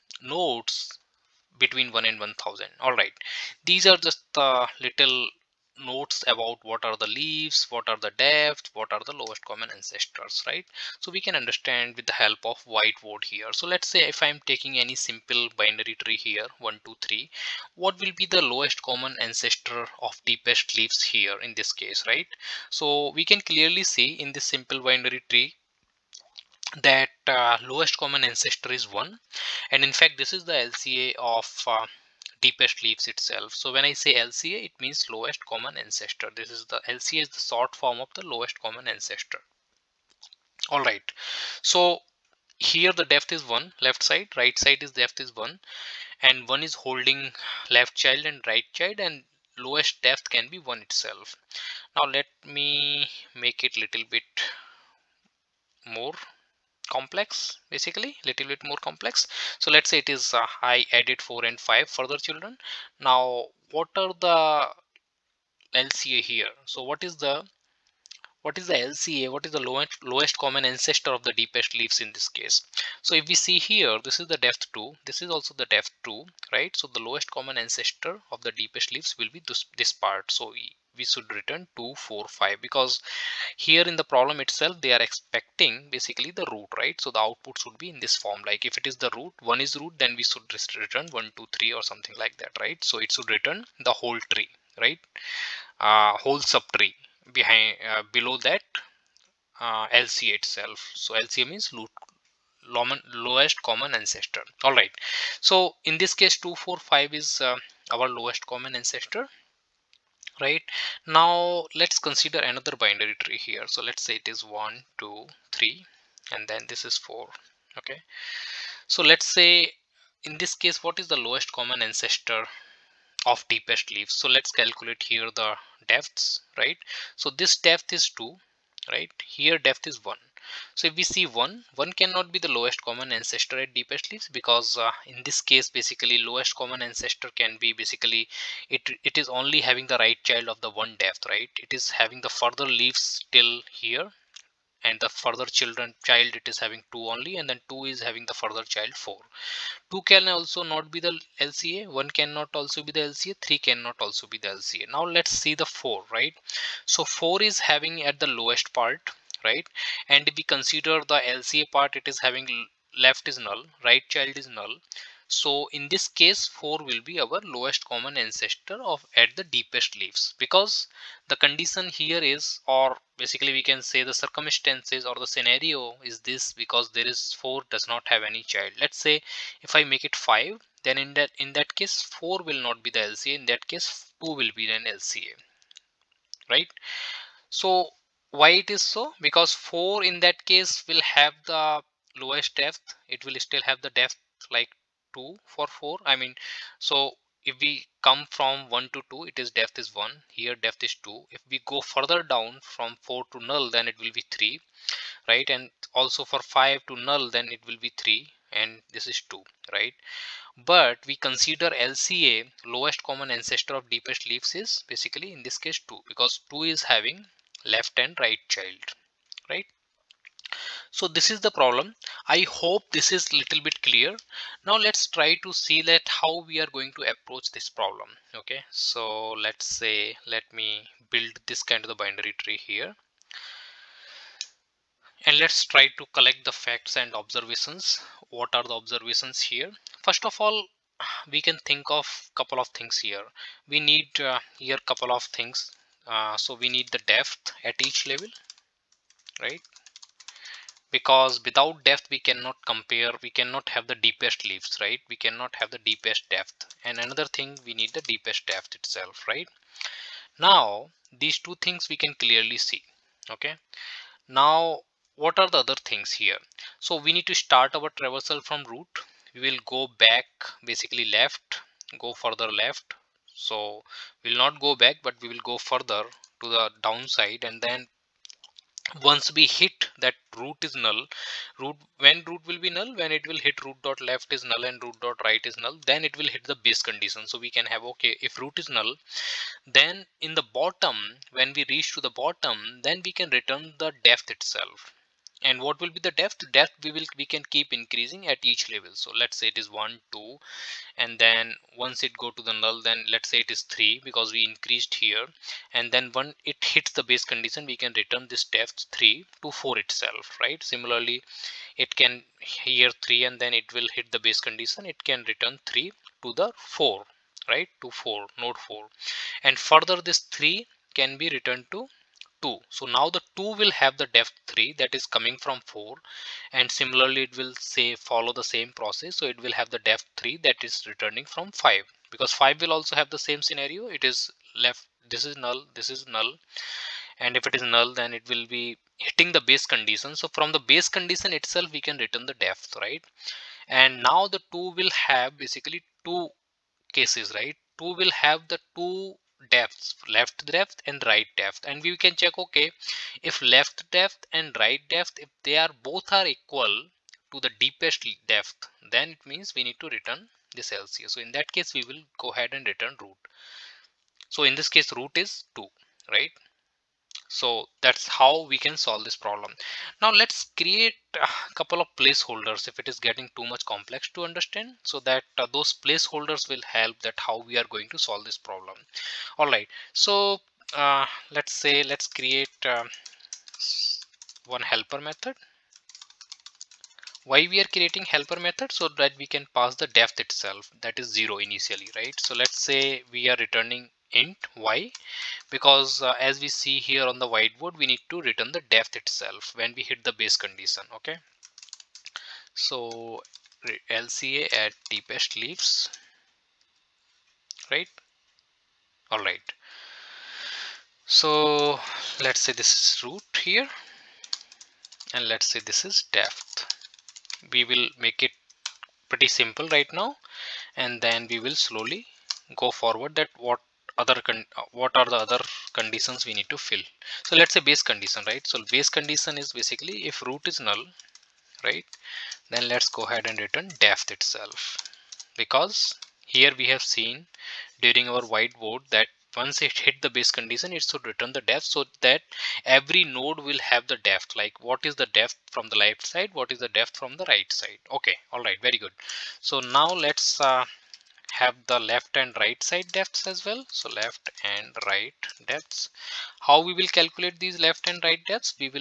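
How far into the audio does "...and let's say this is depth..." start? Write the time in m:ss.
6:55.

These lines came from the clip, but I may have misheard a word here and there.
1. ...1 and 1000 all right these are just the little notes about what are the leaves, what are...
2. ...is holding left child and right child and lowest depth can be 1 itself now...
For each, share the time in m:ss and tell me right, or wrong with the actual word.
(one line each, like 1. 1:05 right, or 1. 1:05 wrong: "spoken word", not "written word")
1. 0:01 right
2. 0:46 right.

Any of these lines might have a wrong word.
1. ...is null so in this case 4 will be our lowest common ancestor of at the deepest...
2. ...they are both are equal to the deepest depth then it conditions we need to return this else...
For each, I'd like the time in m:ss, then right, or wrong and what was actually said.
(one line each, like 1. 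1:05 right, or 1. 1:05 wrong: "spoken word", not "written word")
1. 2:44 right
2. 5:55 wrong: "means", not "conditions".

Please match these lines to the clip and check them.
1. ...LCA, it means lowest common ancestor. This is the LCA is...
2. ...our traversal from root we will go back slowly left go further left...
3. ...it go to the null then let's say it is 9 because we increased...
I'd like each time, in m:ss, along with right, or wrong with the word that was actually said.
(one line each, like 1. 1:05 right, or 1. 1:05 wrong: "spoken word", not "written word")
1. 0:34 right
2. 4:27 wrong: "basically", not "slowly"
3. 5:02 wrong: "3", not "9".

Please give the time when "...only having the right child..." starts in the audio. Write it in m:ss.
2:19.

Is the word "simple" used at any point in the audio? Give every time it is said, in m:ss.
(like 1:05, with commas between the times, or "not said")
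0:14, 0:24, 6:59.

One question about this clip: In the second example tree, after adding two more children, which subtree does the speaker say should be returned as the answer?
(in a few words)
2 4 5.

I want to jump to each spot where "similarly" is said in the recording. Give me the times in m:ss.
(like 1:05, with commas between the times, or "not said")
5:10, 5:26.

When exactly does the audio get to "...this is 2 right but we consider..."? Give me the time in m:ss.
3:28.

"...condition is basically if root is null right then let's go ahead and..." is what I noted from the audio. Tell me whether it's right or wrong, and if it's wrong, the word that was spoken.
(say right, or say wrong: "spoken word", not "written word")
right.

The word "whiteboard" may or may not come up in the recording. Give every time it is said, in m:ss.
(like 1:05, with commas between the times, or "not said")
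0:12, 6:37, 7:18.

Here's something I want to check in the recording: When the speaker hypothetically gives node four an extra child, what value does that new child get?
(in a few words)
5.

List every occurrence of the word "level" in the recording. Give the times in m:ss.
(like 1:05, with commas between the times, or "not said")
4:08, 4:58.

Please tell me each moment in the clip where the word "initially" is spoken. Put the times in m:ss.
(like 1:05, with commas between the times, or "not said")
6:31.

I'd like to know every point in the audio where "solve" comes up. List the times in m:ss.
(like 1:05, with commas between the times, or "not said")
6:08, 6:17.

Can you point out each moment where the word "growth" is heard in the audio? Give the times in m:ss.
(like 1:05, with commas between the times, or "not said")
not said.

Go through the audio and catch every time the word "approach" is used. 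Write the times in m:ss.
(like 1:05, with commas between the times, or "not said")
3:47.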